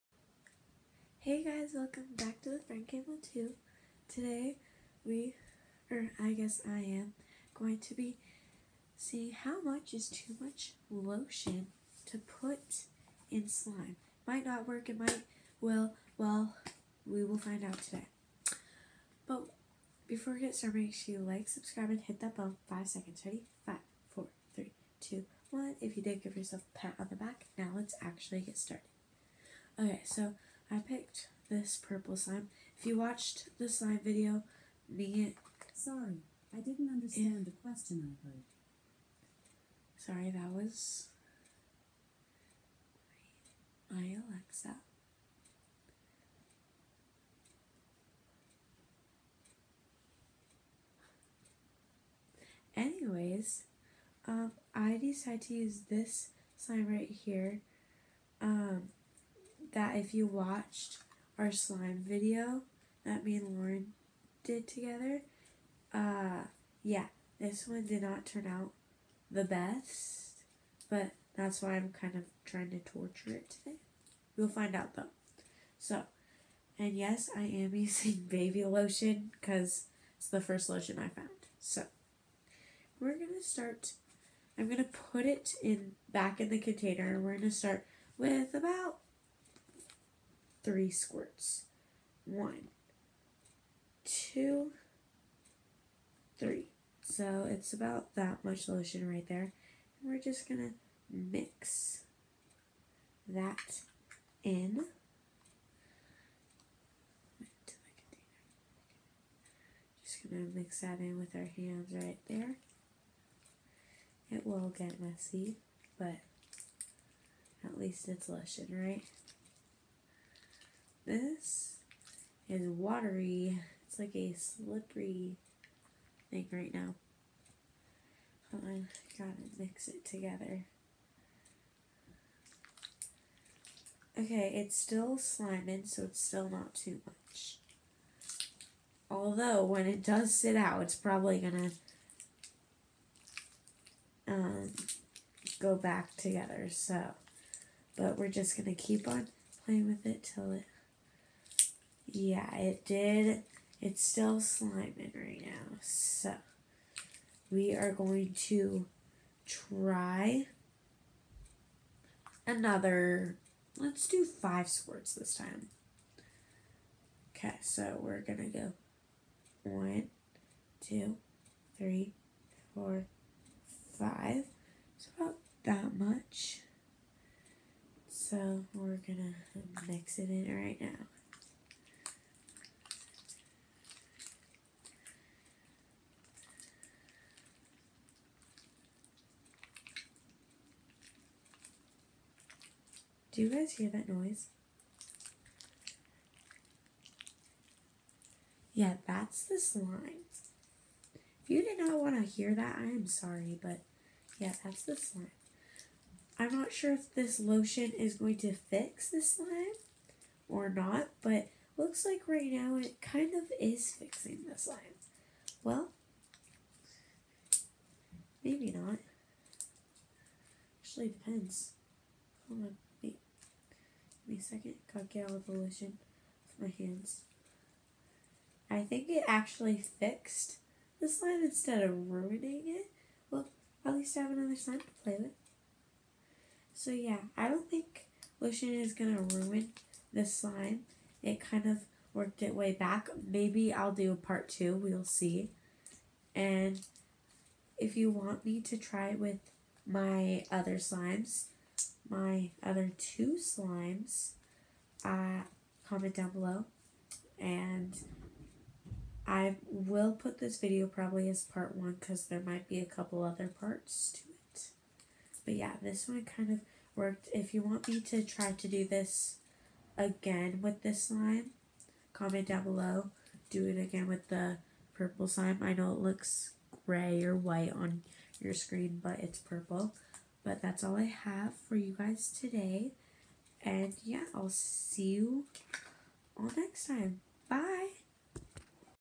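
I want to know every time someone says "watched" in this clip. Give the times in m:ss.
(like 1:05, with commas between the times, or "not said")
0:32, 1:00.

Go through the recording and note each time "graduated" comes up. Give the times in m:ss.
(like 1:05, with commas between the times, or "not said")
not said.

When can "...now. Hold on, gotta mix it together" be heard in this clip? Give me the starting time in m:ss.
2:06.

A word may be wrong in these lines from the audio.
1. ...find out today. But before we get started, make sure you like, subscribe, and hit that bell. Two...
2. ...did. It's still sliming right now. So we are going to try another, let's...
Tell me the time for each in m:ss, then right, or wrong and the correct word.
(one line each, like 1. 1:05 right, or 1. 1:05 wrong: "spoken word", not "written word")
1. 0:17 wrong: "Five", not "Two"
2. 2:32 right.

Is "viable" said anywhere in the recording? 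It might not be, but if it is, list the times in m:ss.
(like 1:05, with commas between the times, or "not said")
not said.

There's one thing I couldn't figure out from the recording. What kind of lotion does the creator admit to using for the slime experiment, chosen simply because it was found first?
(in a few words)
Baby lotion.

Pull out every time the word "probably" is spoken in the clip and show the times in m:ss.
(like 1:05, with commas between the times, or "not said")
2:20, 4:20.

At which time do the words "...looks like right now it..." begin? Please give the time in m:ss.
3:31.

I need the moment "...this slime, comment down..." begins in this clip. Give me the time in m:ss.
4:30.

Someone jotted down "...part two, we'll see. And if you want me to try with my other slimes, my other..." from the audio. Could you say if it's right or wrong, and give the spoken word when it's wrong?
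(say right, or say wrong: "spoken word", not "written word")
right.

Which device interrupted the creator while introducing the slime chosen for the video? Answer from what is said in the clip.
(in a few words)
Alexa.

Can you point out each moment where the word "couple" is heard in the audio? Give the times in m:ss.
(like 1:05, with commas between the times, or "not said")
4:22.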